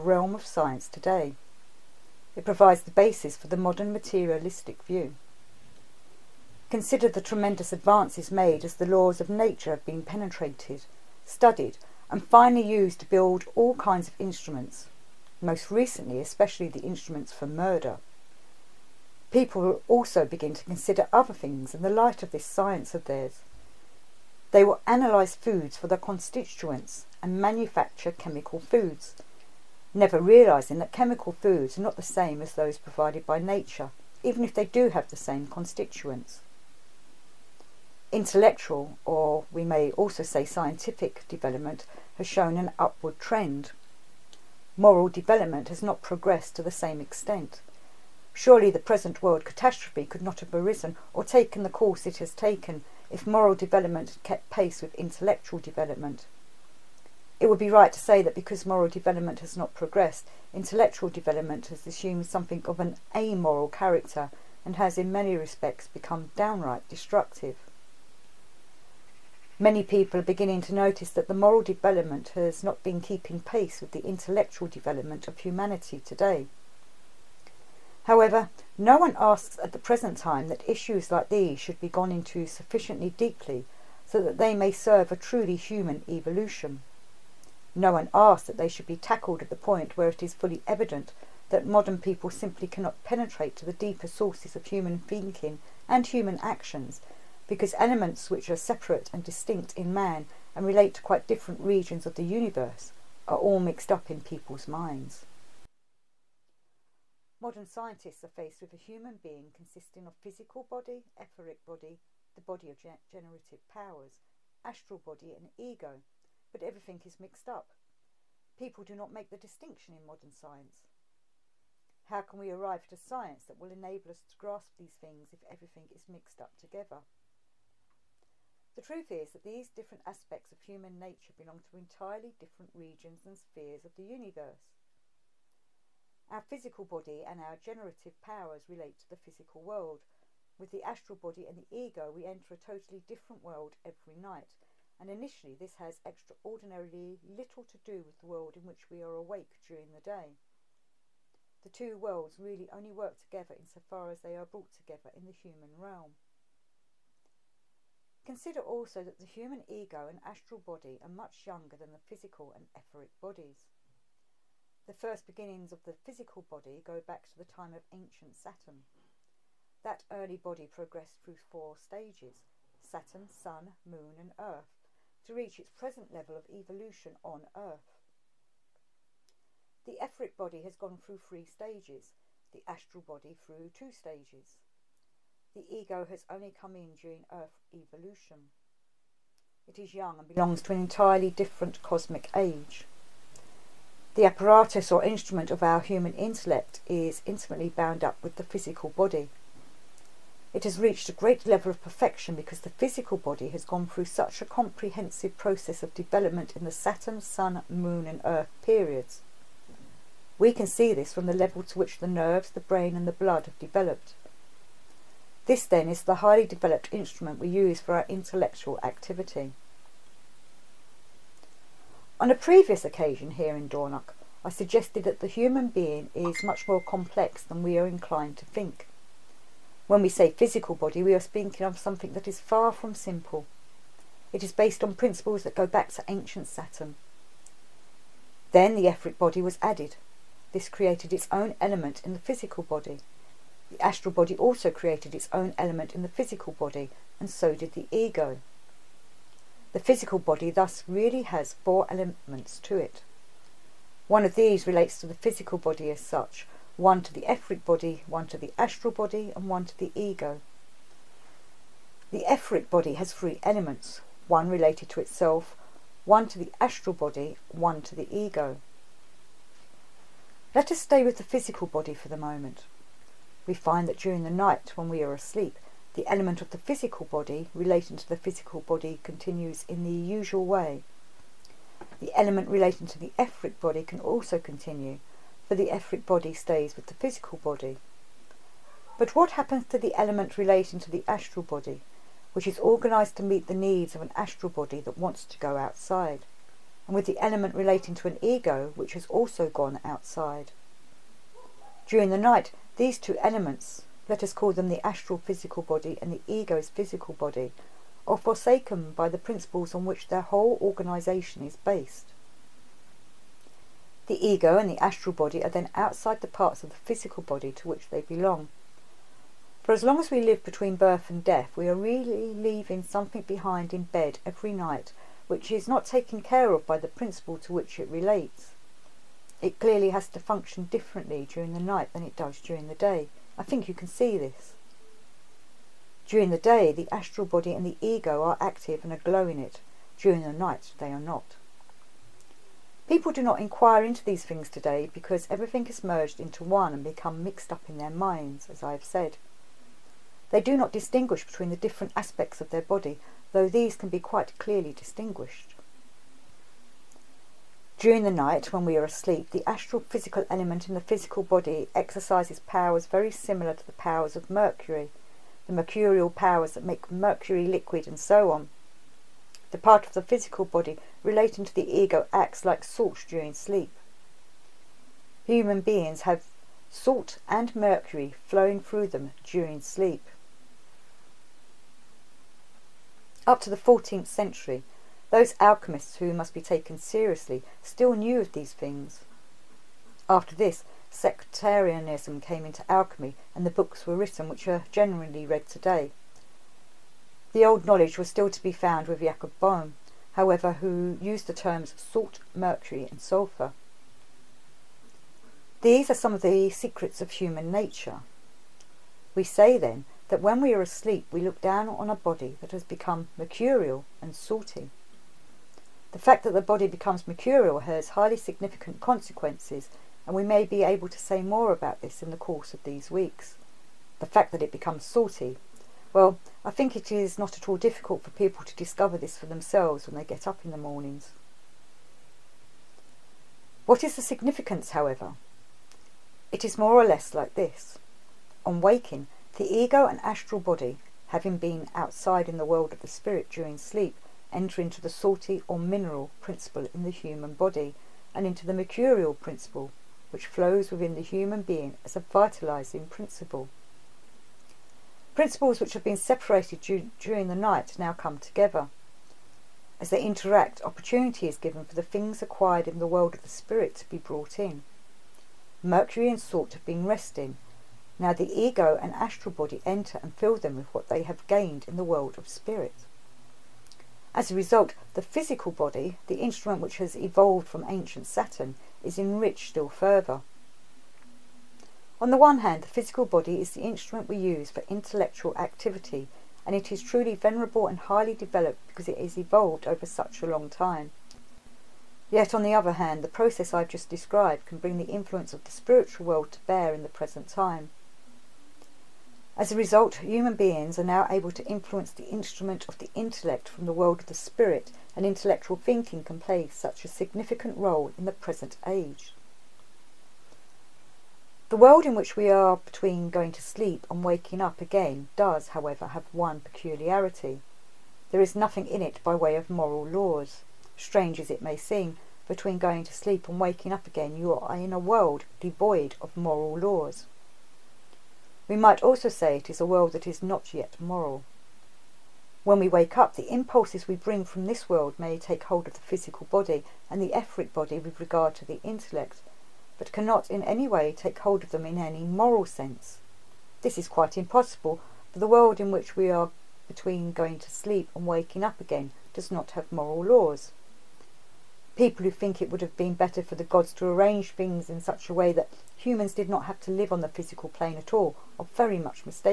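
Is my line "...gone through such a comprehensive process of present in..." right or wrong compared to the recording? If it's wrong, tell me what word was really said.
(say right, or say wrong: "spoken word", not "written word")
wrong: "development", not "present".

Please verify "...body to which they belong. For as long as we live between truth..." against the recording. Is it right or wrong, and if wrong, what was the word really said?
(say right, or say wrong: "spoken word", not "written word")
wrong: "birth", not "truth".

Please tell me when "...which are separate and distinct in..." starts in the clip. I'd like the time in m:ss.
1:38.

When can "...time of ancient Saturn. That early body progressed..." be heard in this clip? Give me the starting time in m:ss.
2:47.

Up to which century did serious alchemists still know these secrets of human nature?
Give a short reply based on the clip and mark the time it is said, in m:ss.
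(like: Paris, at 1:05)
14th century, at 6:23.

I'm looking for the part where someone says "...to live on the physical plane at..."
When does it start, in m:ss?
9:16.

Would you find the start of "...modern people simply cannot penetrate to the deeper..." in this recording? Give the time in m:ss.
1:31.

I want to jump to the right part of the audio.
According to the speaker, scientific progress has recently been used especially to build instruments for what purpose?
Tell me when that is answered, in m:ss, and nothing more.
0:17.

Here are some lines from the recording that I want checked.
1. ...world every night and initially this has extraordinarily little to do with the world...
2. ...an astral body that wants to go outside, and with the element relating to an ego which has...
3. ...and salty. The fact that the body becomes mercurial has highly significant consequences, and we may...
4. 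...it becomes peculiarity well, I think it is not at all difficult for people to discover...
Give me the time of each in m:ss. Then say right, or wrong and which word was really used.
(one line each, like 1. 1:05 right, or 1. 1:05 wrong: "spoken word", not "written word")
1. 2:23 right
2. 4:54 right
3. 6:54 right
4. 7:04 wrong: "salty", not "peculiarity".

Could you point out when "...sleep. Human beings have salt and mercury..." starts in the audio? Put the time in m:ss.
6:13.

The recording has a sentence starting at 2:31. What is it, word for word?
The two worlds really only work together insofar as they are brought together in the human realm.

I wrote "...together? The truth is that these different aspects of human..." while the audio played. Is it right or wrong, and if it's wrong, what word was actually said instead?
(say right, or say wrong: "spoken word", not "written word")
right.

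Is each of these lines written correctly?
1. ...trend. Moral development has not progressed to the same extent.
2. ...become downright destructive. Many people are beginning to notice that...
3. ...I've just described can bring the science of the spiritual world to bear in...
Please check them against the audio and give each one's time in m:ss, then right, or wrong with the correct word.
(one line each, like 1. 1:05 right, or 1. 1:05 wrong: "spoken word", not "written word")
1. 0:43 right
2. 1:05 right
3. 8:13 wrong: "influence", not "science".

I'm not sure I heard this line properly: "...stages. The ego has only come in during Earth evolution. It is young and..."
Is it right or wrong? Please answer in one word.
right.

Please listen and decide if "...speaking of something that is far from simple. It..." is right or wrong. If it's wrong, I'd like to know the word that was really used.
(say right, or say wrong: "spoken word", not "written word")
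right.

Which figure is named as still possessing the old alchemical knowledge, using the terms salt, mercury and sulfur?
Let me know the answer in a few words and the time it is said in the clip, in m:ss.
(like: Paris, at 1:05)
Jacob Boehme, at 6:38.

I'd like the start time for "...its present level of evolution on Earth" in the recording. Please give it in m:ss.
2:55.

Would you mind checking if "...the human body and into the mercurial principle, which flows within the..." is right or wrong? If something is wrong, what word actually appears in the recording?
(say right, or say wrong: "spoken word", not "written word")
right.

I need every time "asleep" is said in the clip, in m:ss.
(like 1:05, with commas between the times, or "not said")
4:35, 5:58, 6:50.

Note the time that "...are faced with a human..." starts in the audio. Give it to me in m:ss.
1:48.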